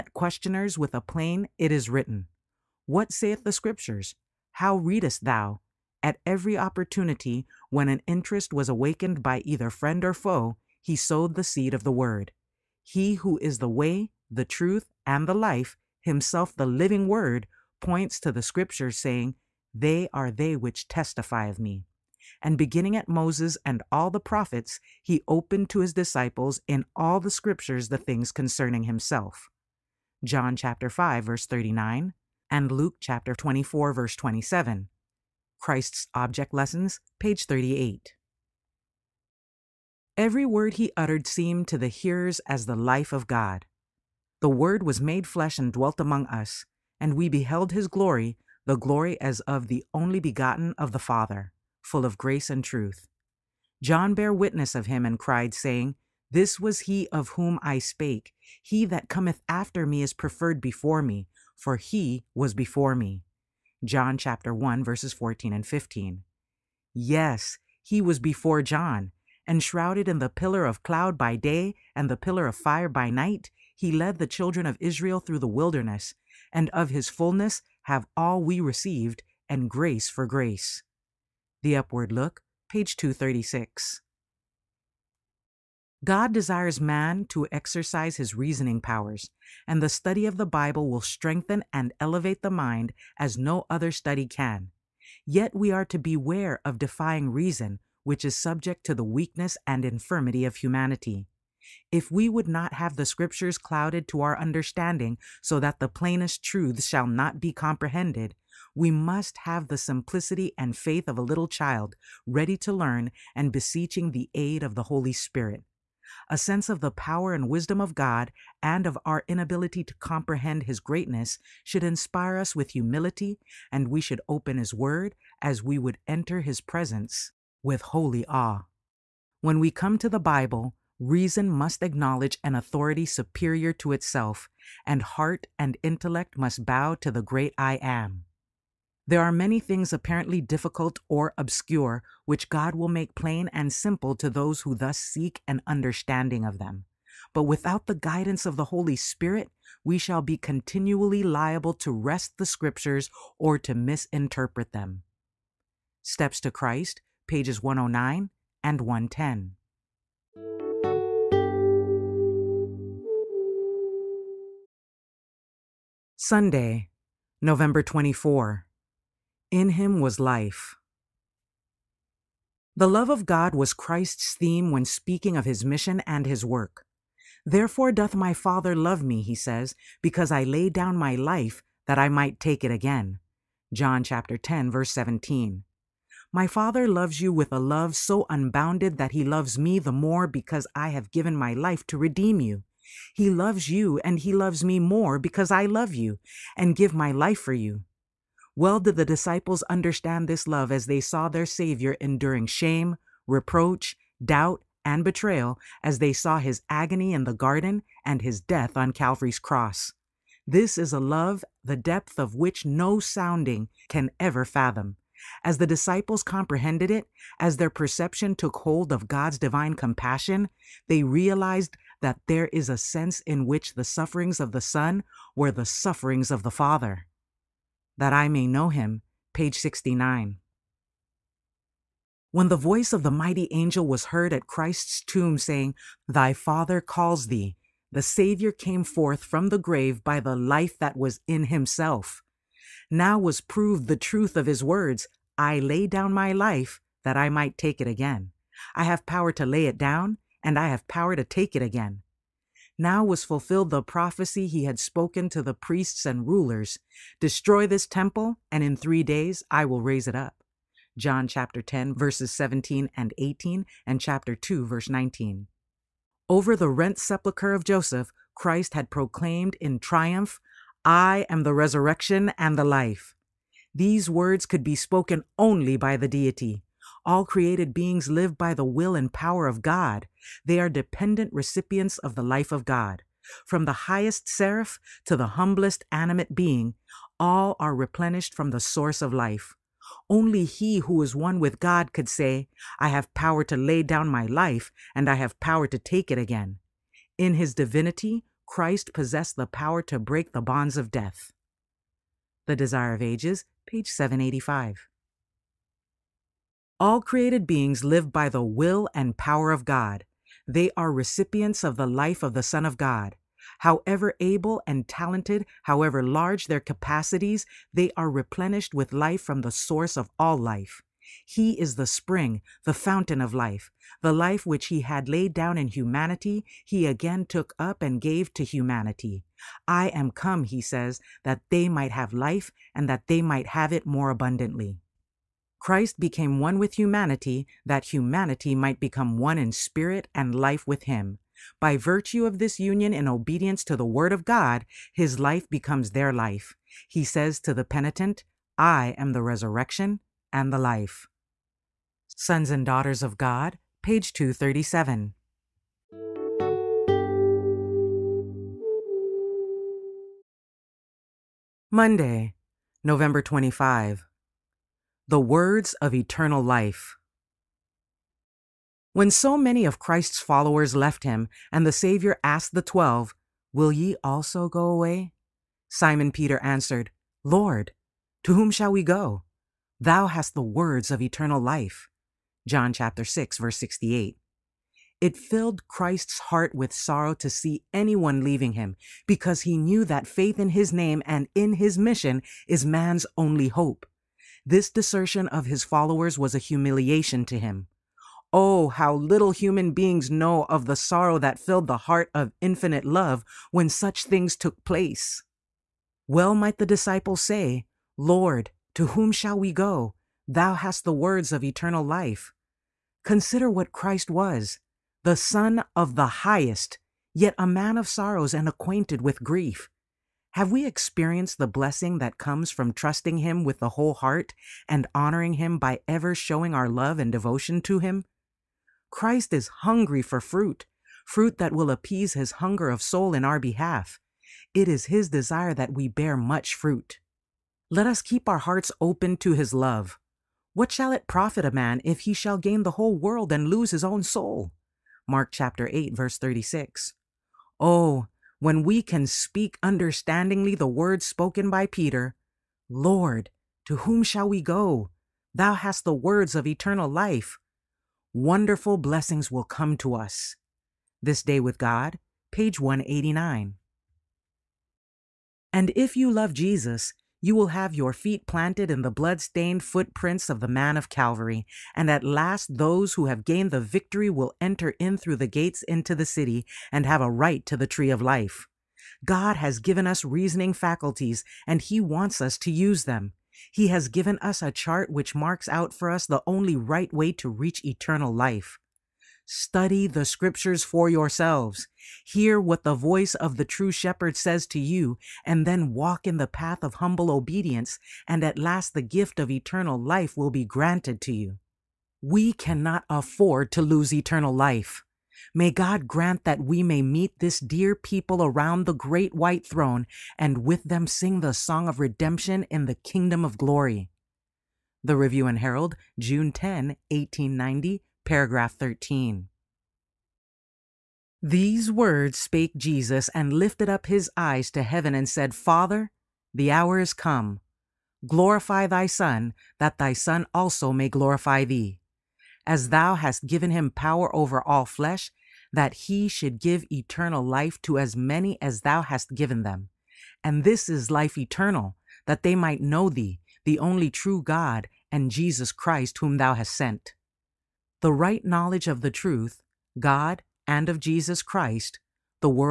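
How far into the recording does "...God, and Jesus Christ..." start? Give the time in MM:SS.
09:04.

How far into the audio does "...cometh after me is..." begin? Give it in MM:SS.
00:59.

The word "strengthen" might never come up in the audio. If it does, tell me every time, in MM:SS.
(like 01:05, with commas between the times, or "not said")
01:30.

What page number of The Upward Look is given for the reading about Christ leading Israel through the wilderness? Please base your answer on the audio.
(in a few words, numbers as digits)
236.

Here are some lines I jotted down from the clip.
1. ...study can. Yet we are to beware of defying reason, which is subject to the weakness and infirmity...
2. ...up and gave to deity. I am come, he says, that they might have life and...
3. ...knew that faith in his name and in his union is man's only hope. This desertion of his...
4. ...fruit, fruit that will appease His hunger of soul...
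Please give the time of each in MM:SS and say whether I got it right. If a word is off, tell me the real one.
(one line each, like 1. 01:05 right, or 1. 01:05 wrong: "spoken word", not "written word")
1. 01:33 right
2. 05:27 wrong: "humanity", not "deity"
3. 06:29 wrong: "mission", not "union"
4. 07:10 right.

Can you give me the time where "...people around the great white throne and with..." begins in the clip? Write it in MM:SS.
08:27.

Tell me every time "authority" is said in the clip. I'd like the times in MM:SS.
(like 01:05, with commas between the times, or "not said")
02:12.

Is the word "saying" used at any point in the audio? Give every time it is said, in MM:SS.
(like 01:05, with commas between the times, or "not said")
00:18, 00:55, 03:55.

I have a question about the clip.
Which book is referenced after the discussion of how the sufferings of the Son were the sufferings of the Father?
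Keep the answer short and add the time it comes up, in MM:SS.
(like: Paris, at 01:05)
That I may know him, at 03:47.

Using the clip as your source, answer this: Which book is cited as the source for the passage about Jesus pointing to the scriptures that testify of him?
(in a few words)
Christ's Object Lessons.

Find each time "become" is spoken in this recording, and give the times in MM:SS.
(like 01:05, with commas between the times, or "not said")
05:38, 05:45.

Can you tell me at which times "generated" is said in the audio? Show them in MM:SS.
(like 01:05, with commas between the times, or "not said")
not said.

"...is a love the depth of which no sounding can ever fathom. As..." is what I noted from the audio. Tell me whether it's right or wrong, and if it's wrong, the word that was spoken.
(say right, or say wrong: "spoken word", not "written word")
right.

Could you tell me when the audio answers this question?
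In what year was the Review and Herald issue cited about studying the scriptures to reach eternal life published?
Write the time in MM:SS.
08:36.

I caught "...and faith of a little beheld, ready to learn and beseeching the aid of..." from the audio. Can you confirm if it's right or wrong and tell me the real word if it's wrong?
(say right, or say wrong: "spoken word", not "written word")
wrong: "child", not "beheld".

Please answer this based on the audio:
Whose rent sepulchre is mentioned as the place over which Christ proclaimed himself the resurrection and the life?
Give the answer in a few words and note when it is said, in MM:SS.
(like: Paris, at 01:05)
Joseph, at 04:27.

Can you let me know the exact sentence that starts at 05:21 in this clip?
He is the spring, the fountain of life.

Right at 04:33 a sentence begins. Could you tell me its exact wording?
These words could be spoken only by the deity.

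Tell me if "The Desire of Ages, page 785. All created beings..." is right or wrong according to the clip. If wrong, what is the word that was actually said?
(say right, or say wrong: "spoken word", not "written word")
right.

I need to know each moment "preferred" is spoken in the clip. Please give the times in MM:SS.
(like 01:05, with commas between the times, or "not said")
01:00.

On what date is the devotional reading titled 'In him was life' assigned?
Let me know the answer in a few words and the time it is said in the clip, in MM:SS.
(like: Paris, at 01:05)
Sunday, November 24, at 02:46.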